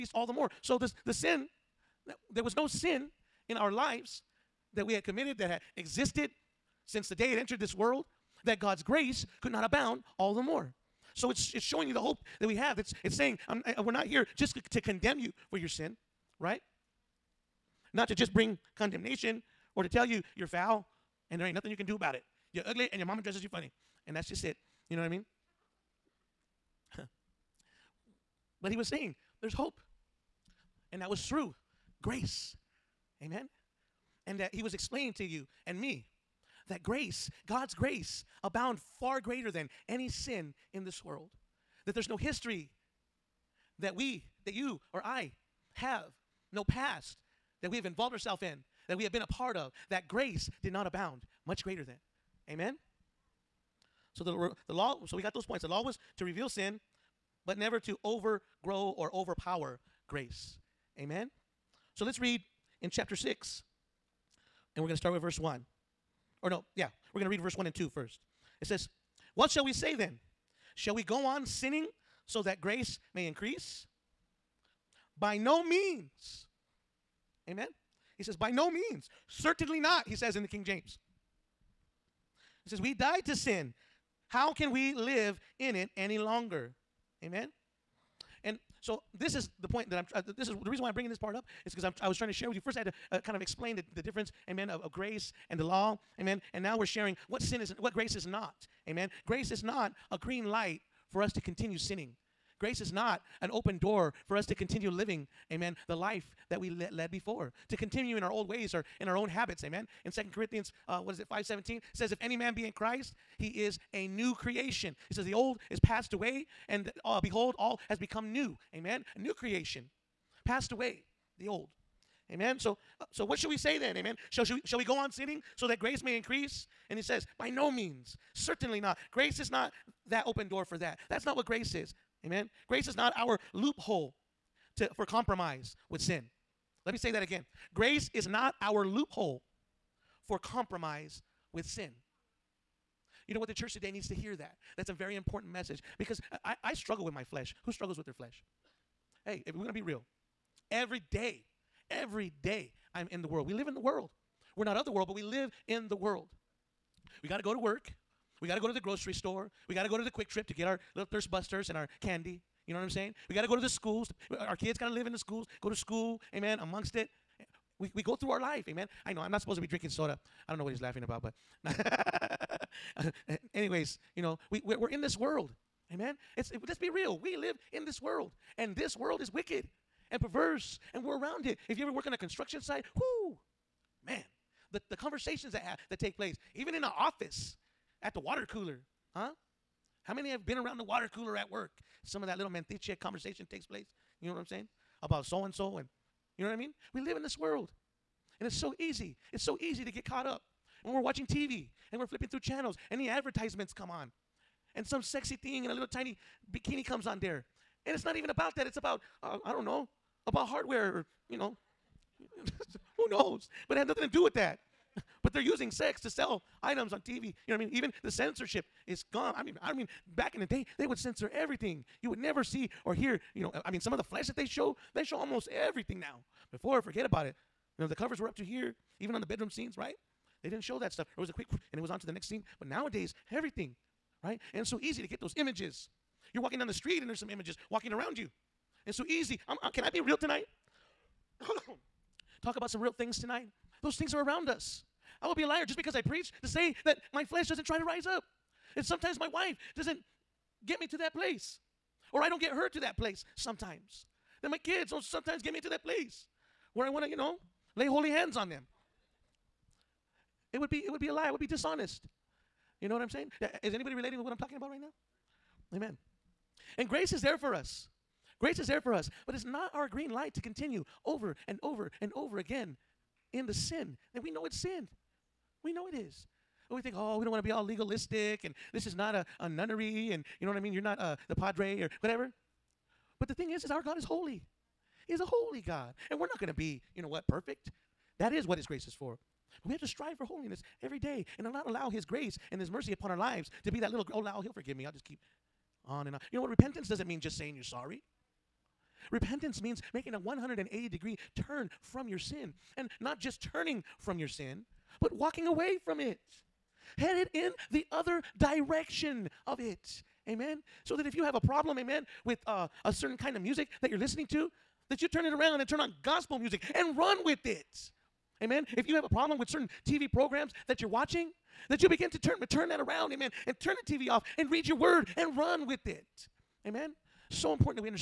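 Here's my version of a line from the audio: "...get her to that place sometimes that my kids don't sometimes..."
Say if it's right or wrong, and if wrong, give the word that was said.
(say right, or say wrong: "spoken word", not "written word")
right.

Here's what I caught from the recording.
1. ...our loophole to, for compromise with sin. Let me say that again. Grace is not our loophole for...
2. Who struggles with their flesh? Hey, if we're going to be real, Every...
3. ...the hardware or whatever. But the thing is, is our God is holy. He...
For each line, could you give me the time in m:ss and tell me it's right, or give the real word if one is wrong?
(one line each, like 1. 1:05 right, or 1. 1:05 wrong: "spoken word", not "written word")
1. 2:13 right
2. 2:27 right
3. 4:41 wrong: "padre", not "hardware".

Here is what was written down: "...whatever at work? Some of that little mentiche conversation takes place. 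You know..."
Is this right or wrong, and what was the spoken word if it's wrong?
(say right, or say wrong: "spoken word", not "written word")
wrong: "cooler", not "whatever".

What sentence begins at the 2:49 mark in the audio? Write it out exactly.
I know I'm not supposed to be drinking soda.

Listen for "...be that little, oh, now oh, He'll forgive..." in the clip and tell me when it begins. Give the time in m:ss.
4:53.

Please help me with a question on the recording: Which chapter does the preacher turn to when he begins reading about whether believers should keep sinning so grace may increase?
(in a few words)
Chapter 6.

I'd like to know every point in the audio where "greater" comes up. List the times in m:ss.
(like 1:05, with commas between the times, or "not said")
0:39, 0:51.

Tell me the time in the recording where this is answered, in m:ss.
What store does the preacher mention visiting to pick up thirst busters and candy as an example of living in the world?
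2:40.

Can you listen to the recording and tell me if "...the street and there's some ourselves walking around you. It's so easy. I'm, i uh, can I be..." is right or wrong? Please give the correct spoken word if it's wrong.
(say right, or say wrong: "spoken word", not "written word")
wrong: "images", not "ourselves".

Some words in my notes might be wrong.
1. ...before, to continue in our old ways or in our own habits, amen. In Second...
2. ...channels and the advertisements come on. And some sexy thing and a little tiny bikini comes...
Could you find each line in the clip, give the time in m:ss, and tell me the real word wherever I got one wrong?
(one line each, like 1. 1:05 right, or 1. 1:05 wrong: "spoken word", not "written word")
1. 1:47 right
2. 3:22 right.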